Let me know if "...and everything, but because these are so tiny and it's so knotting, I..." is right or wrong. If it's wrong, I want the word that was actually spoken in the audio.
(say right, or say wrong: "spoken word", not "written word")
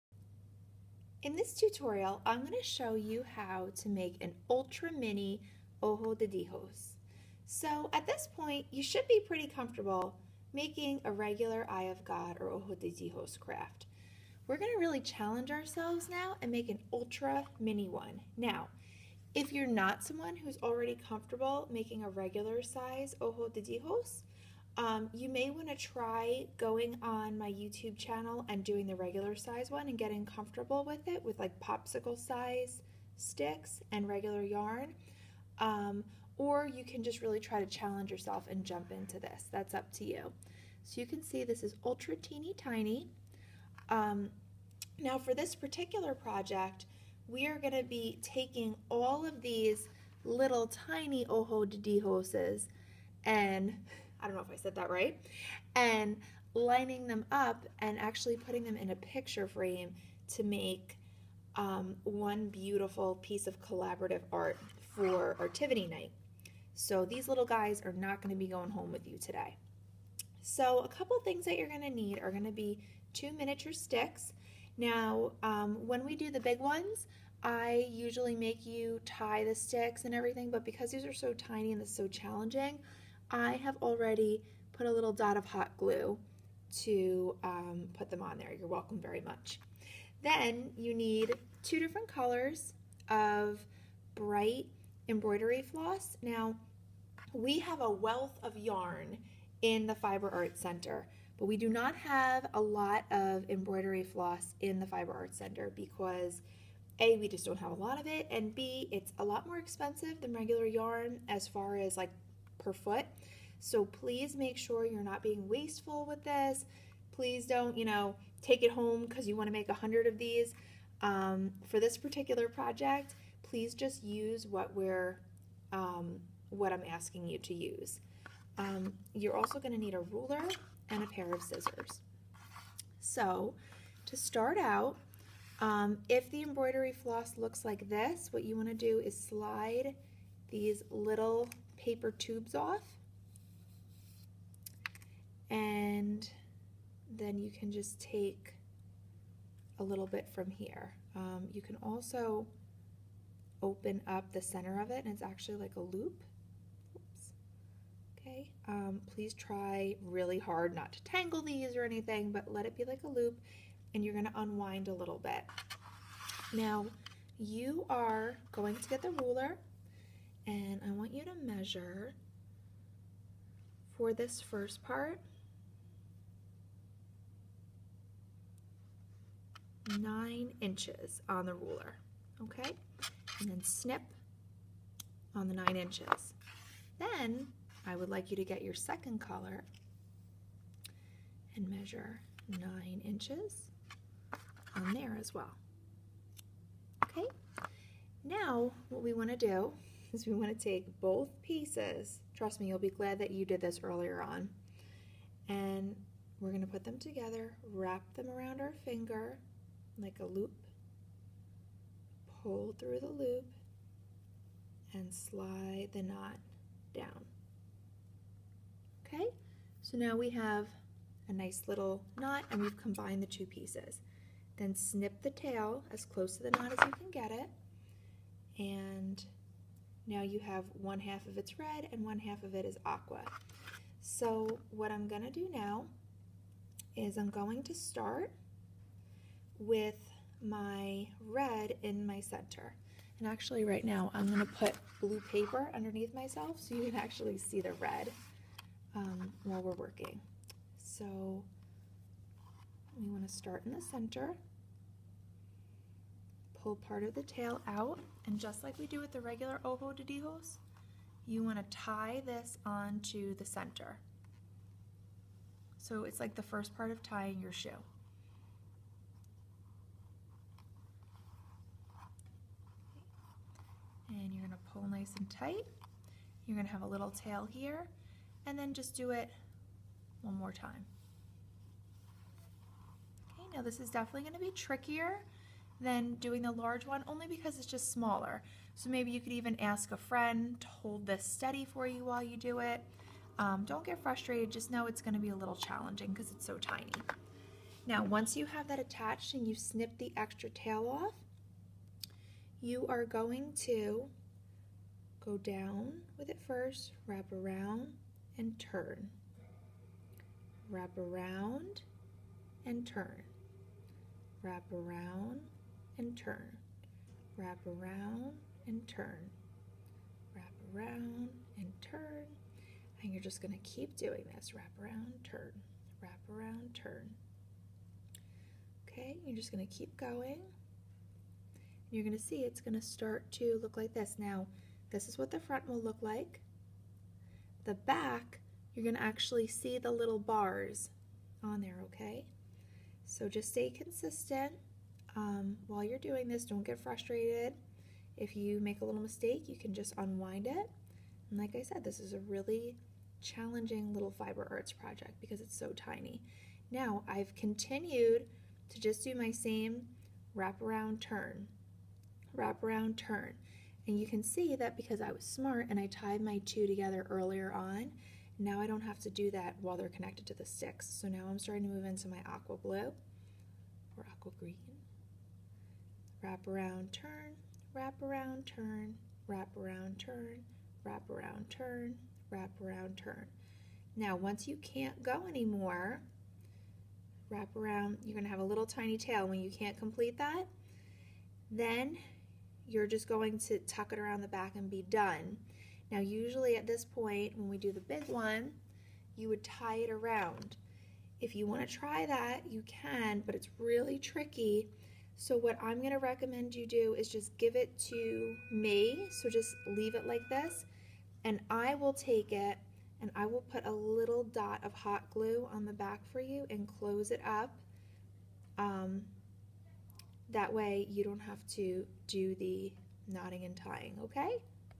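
wrong: "challenging", not "knotting".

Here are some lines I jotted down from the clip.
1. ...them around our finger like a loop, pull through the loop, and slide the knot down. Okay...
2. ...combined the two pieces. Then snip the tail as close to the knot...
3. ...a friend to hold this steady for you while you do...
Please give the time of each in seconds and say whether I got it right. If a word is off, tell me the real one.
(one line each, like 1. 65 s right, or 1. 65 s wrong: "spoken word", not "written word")
1. 208 s right
2. 222 s right
3. 289 s right.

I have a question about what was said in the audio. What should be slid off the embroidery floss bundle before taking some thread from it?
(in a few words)
Little paper tubes.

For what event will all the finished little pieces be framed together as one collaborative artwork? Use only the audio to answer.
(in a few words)
Artivity Night.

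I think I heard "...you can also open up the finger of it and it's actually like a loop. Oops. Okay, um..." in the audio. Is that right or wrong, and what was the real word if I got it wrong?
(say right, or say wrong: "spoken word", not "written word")
wrong: "center", not "finger".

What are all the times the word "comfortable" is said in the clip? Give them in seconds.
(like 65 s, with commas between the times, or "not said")
9 s, 21 s, 30 s.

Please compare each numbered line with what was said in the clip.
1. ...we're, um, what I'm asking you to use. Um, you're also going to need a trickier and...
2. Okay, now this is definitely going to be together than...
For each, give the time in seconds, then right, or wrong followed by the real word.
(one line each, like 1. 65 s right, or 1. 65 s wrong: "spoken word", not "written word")
1. 124 s wrong: "ruler", not "trickier"
2. 283 s wrong: "trickier", not "together".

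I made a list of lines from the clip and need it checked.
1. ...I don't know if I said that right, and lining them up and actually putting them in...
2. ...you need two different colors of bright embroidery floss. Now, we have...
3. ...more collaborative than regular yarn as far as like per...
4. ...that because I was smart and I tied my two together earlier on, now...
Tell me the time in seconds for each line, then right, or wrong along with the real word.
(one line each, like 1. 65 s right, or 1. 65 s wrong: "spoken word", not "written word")
1. 54 s right
2. 90 s right
3. 109 s wrong: "expensive", not "collaborative"
4. 364 s right.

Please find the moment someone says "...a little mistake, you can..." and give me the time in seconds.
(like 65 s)
348 s.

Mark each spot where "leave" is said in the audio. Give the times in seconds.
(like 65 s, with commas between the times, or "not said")
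409 s.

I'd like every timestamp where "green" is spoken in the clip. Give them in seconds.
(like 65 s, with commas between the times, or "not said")
374 s.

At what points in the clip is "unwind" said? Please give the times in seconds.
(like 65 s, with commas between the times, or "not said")
164 s, 349 s.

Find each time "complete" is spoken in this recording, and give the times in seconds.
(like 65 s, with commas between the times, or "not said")
389 s.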